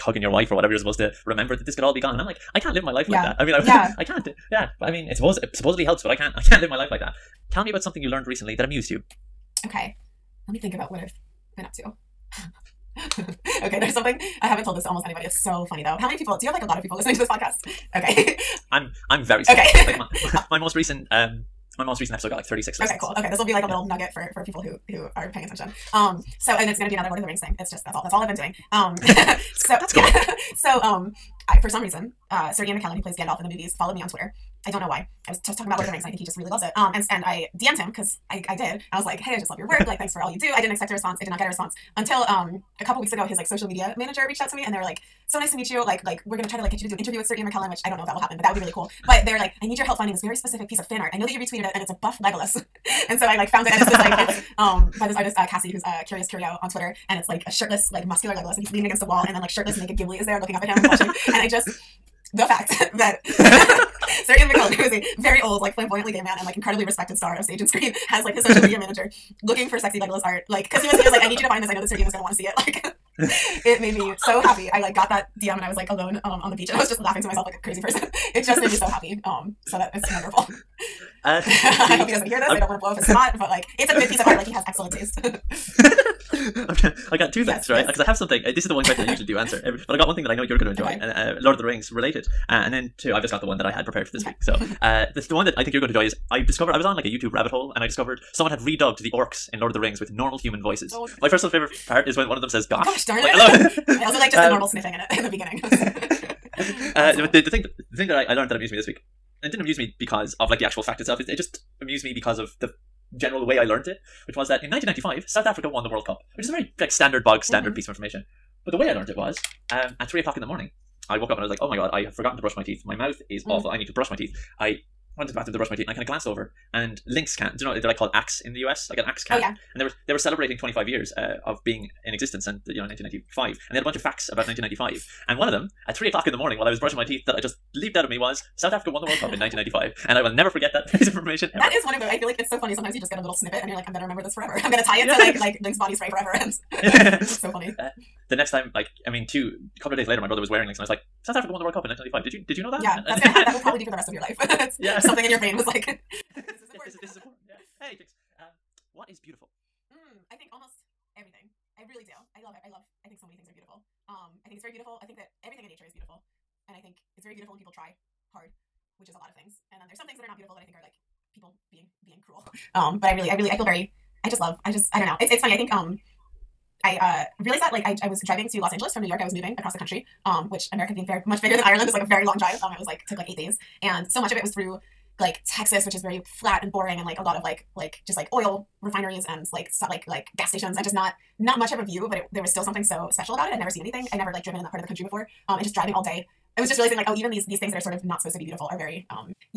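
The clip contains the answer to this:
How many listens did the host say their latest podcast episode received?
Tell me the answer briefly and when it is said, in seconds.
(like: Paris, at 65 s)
36, at 22 s.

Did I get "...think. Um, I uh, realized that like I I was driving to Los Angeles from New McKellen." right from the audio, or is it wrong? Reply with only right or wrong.
wrong.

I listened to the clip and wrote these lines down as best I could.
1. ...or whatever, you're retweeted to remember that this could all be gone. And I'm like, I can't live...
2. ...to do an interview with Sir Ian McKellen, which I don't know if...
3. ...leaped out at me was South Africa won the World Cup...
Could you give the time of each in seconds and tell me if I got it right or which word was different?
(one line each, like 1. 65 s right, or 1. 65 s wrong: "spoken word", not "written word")
1. 0 s wrong: "supposed", not "retweeted"
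2. 46 s right
3. 137 s right.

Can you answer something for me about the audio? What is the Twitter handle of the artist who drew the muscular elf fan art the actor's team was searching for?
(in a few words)
Curious Curio.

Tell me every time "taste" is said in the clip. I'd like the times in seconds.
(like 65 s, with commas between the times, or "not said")
84 s.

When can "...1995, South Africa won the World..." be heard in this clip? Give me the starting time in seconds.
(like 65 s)
114 s.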